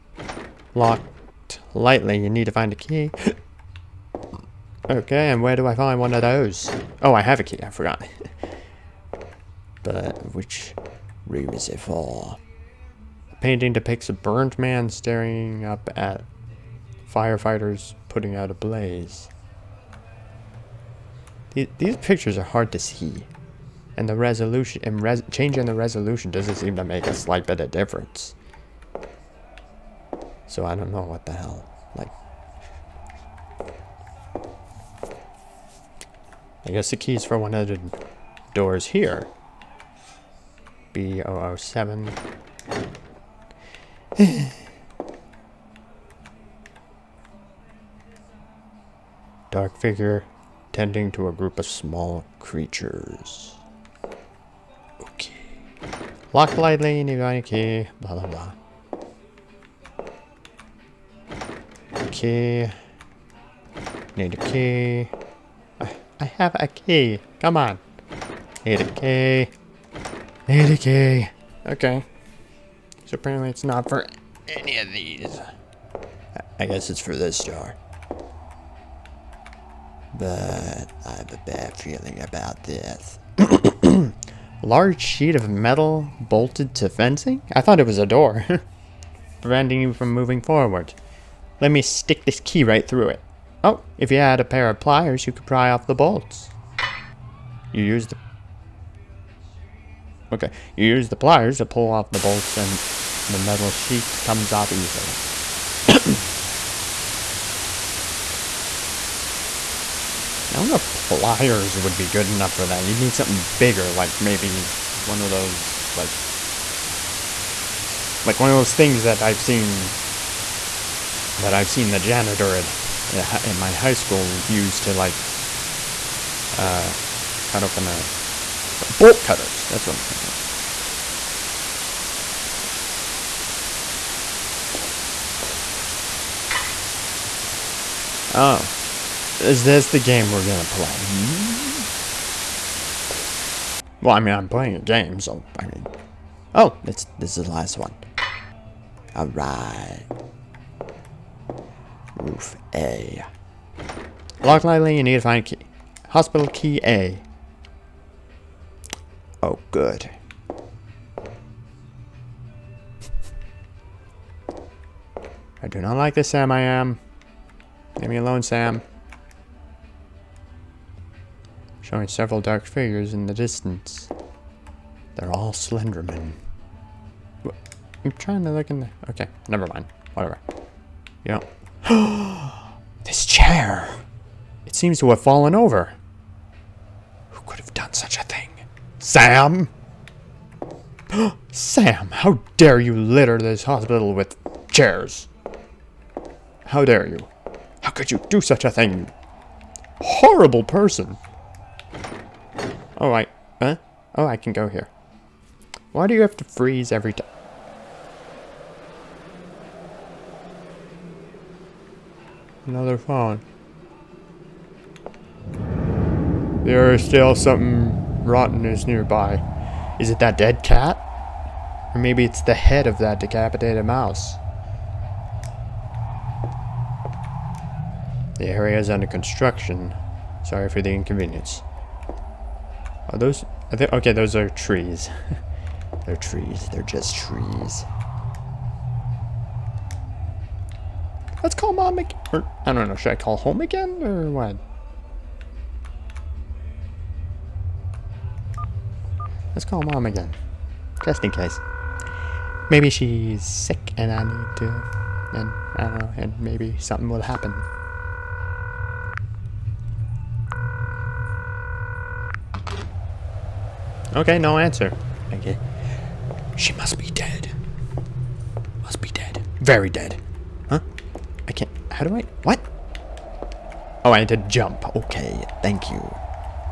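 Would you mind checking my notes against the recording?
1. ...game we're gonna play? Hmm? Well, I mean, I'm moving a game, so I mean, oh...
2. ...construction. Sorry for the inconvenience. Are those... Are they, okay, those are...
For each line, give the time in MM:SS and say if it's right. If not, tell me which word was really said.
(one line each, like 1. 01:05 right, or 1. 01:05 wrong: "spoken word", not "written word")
1. 02:19 wrong: "playing", not "moving"
2. 03:49 right.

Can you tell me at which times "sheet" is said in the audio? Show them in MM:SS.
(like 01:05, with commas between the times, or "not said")
01:25, 01:43.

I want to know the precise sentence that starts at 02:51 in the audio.
Showing several dark figures in the distance.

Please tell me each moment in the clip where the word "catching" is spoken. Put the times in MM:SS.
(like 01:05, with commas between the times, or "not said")
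not said.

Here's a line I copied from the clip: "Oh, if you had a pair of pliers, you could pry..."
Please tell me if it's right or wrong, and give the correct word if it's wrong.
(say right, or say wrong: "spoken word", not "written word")
right.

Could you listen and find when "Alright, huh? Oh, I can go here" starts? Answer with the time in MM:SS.
03:22.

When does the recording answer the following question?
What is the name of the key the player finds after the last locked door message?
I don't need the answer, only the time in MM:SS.
02:36.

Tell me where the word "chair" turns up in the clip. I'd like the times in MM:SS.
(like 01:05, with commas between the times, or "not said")
03:03, 03:14.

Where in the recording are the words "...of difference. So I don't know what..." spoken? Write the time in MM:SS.
00:27.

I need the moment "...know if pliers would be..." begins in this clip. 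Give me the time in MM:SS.
01:50.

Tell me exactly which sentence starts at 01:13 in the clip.
So apparently it's not for any of these.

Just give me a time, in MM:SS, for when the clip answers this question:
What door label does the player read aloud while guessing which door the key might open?
00:40.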